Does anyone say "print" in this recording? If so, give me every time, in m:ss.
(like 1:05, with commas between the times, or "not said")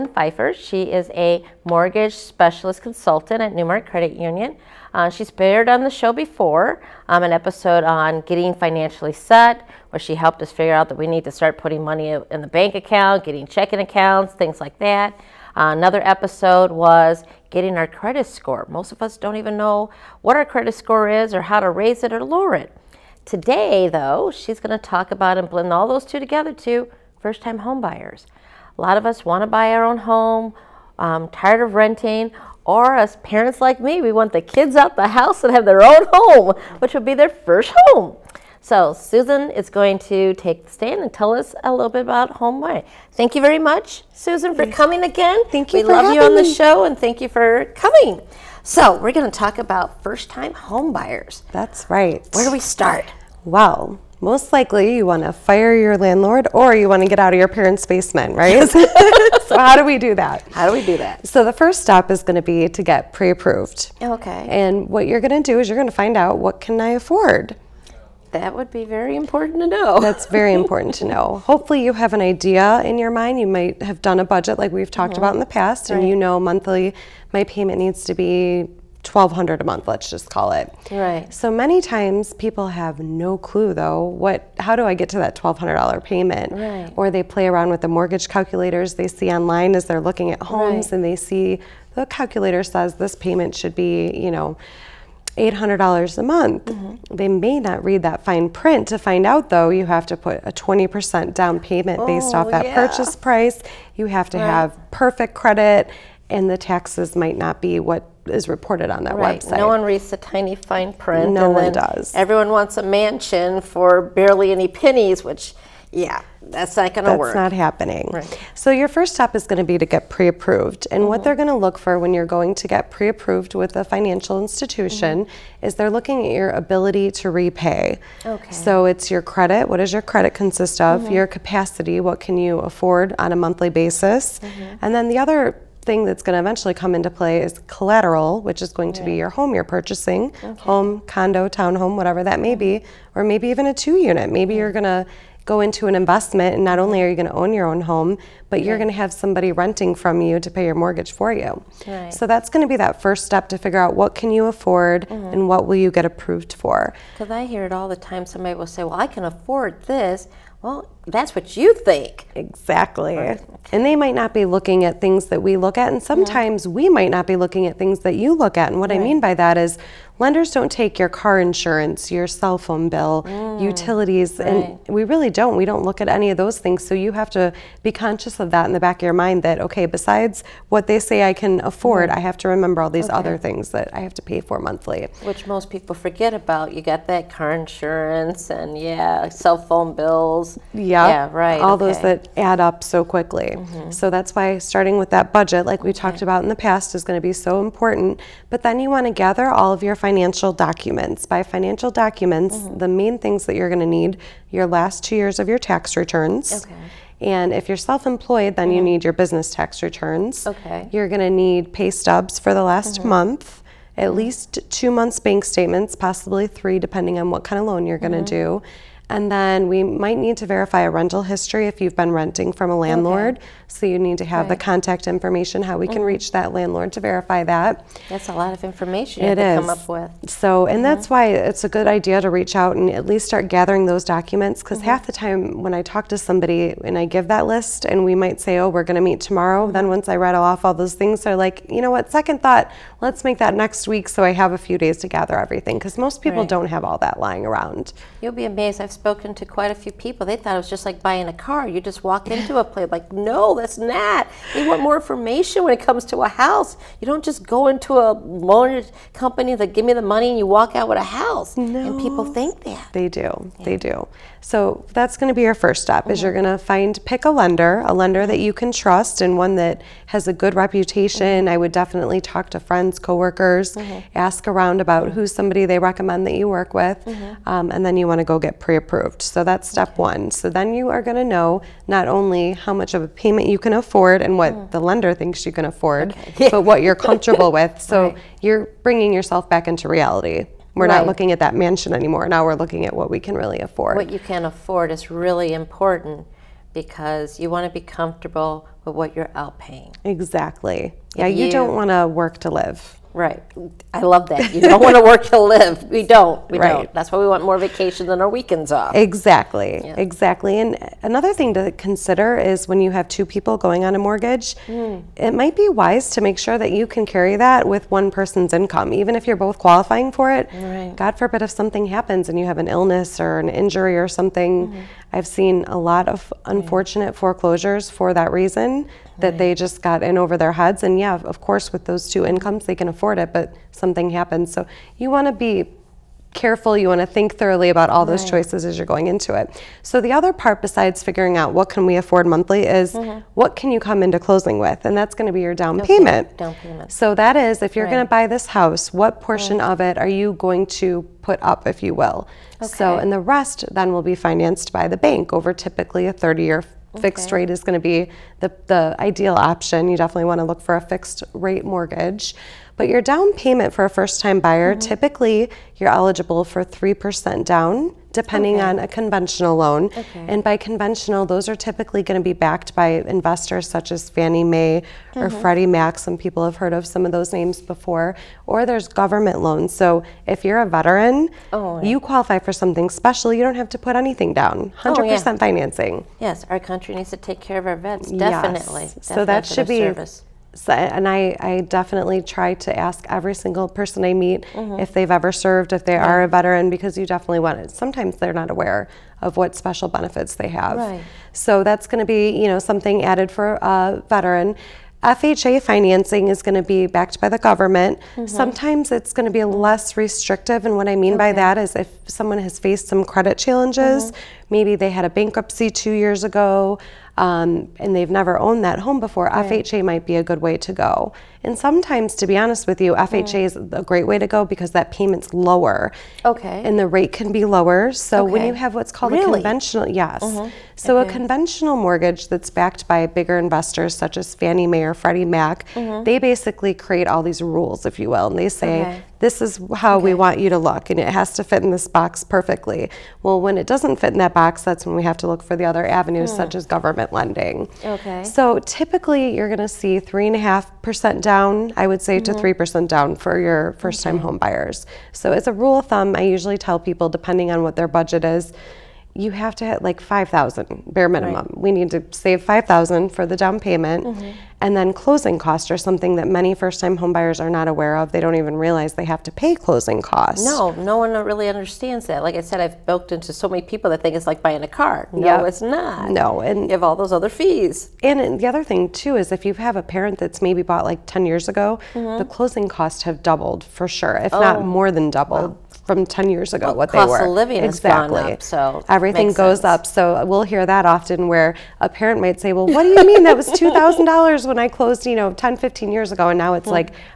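1:38, 1:50.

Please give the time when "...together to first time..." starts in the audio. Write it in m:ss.
0:26.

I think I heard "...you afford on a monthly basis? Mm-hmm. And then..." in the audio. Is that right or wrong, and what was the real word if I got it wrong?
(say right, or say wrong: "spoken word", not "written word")
right.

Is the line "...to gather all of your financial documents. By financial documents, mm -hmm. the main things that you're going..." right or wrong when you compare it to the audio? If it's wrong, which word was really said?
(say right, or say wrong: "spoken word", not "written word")
right.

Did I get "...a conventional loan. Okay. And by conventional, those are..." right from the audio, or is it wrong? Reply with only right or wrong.
right.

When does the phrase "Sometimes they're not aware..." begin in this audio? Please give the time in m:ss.
6:37.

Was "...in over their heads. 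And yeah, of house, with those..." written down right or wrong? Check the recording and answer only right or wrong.
wrong.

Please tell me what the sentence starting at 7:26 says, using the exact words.
as government lending okay so typically you're going to see 3.5% down i would say mm -hmm.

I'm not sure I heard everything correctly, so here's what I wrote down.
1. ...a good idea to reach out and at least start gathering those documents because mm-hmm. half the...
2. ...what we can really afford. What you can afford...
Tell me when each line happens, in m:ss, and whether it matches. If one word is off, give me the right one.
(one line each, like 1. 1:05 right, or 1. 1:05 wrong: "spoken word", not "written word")
1. 3:51 right
2. 4:52 right.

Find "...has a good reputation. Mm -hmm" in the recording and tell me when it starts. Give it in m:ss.
4:30.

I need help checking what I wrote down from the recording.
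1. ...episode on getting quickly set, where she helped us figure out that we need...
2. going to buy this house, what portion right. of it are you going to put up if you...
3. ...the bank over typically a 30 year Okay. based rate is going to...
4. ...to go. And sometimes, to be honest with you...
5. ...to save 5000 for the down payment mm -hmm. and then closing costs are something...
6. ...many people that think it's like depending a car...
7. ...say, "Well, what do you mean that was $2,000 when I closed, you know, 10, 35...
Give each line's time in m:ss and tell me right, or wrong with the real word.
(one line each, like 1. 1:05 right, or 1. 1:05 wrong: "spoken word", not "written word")
1. 0:07 wrong: "financially", not "quickly"
2. 5:47 right
3. 5:54 wrong: "fixed", not "based"
4. 7:00 right
5. 7:41 right
6. 7:53 wrong: "buying", not "depending"
7. 8:12 wrong: "15", not "35".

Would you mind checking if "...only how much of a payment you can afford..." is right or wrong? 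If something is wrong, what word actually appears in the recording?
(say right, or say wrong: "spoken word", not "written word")
right.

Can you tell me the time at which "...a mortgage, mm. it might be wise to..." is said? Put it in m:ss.
5:13.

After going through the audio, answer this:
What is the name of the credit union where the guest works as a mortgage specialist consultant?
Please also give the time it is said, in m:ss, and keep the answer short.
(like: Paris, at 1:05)
NuMark Credit Union, at 0:03.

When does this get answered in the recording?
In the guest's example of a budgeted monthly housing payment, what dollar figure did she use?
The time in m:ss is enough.
1:19.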